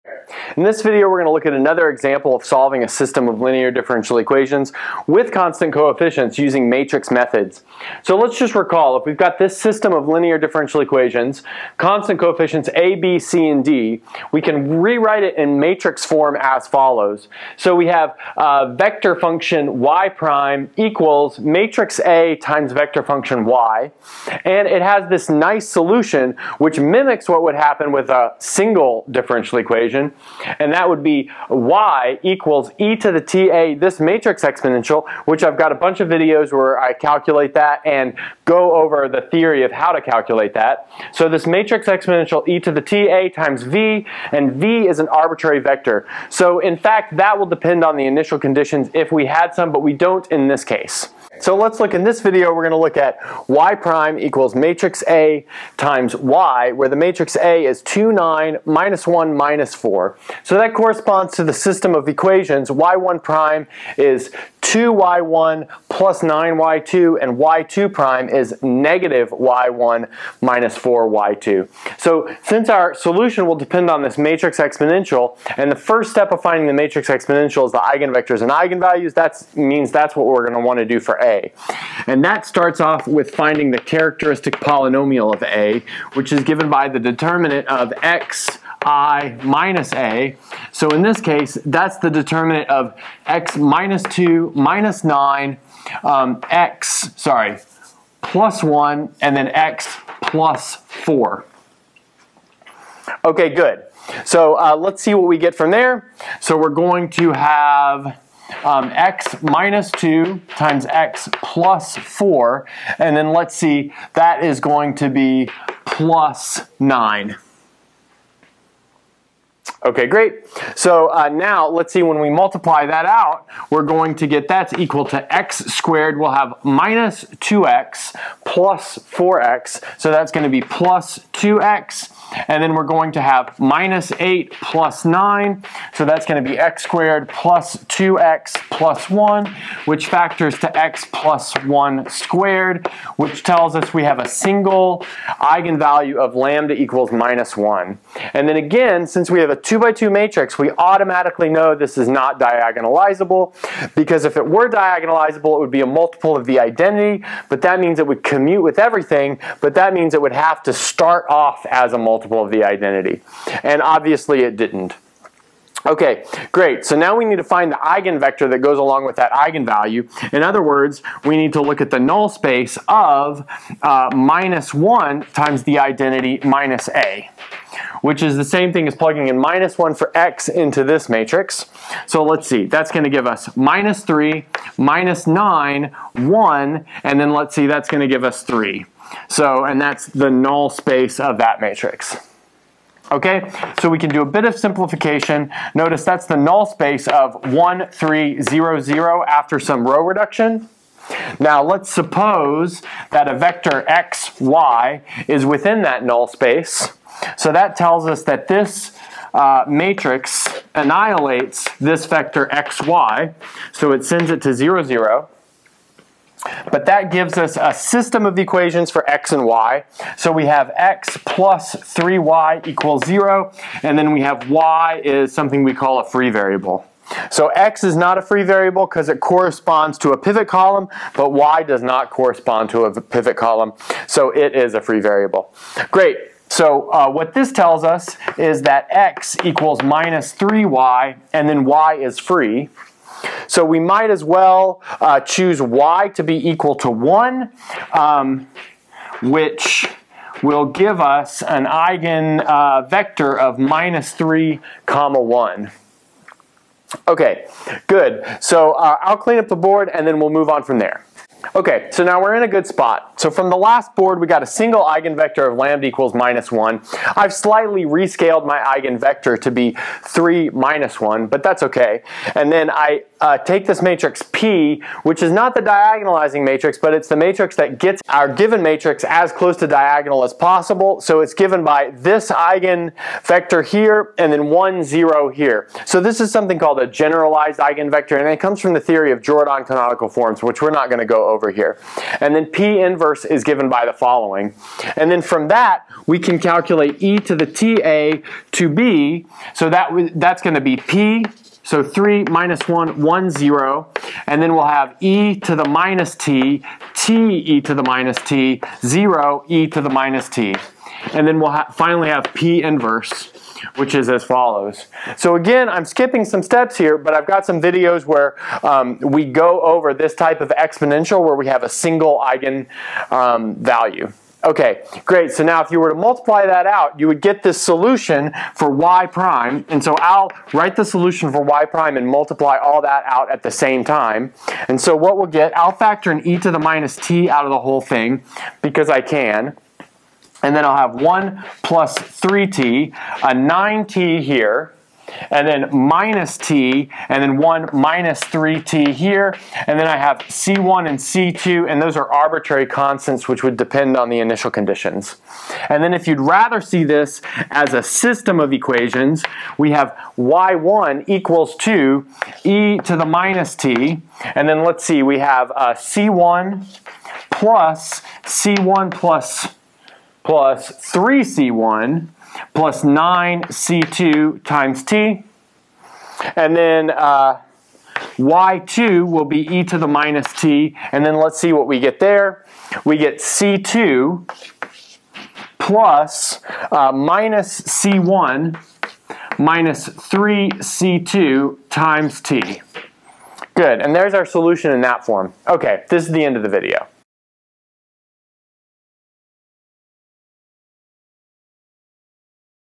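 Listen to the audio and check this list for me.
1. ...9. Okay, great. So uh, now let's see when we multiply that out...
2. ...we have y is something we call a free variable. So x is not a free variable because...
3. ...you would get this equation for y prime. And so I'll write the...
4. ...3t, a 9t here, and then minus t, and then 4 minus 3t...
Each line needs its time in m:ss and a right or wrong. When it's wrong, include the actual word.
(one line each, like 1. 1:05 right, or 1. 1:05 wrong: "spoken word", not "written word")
1. 1:56 right
2. 3:44 right
3. 5:26 wrong: "solution", not "equation"
4. 5:41 wrong: "1", not "4".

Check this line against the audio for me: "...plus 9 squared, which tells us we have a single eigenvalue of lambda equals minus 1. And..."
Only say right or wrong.
wrong.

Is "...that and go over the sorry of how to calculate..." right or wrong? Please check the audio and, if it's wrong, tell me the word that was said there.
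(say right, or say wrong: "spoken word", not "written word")
wrong: "theory", not "sorry".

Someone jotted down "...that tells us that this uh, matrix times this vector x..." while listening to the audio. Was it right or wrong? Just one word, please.
wrong.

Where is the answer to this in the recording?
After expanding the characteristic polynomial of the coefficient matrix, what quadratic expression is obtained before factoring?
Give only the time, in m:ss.
2:16.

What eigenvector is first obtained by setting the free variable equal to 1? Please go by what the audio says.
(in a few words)
(-3, 1).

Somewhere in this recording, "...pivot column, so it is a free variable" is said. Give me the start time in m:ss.
3:53.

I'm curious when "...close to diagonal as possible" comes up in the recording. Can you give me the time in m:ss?
4:39.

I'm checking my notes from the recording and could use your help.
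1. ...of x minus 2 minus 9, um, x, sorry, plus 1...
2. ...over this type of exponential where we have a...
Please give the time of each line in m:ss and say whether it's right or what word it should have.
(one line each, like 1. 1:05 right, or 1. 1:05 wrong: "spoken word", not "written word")
1. 1:32 right
2. 5:19 right.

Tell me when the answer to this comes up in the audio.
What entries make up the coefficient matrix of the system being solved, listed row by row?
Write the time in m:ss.
0:57.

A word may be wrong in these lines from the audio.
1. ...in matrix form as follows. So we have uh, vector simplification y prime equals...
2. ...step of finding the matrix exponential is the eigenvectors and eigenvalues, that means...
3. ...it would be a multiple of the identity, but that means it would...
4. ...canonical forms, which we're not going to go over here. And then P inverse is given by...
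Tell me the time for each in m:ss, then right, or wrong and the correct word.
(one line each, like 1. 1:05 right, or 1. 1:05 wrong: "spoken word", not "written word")
1. 0:15 wrong: "function", not "simplification"
2. 1:16 right
3. 2:35 right
4. 4:49 right.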